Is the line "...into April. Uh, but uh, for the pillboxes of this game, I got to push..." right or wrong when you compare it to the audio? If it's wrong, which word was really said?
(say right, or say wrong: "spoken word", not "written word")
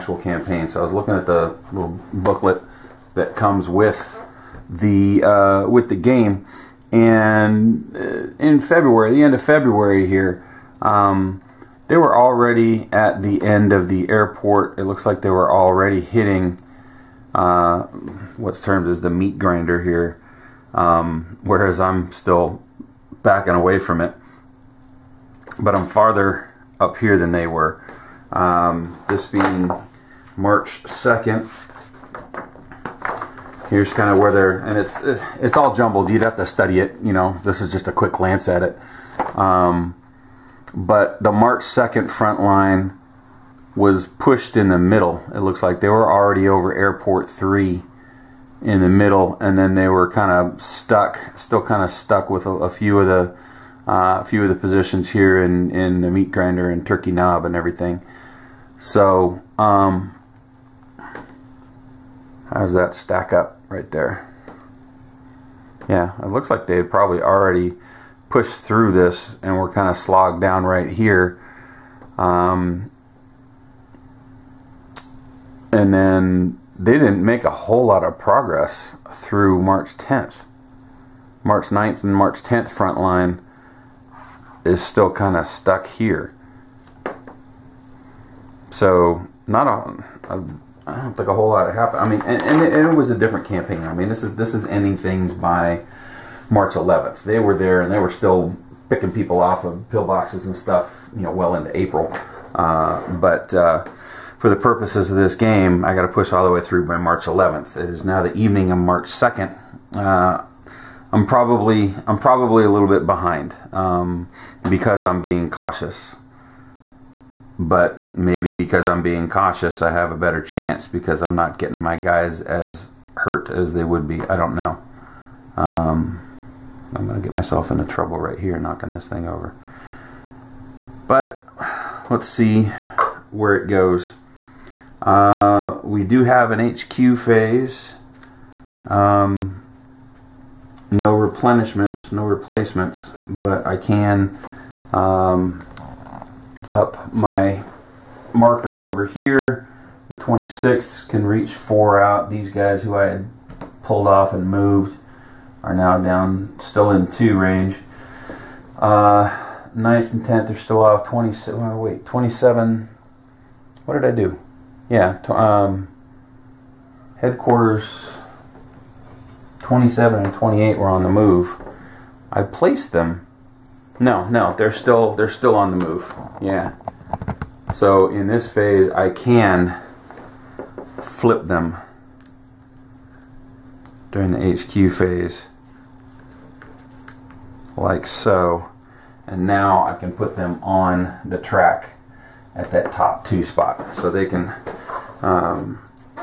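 wrong: "purposes", not "pillboxes".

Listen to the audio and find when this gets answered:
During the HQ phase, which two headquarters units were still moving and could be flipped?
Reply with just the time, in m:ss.
2:49.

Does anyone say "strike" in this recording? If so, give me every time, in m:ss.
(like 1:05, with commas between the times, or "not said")
not said.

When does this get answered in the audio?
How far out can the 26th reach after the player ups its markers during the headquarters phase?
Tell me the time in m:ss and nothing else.
2:31.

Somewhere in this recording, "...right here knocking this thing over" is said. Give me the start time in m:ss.
2:08.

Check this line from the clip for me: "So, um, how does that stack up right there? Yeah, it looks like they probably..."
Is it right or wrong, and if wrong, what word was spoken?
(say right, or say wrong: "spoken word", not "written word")
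right.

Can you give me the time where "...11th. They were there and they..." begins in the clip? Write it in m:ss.
1:36.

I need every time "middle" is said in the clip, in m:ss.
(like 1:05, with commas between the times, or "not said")
0:44, 0:48.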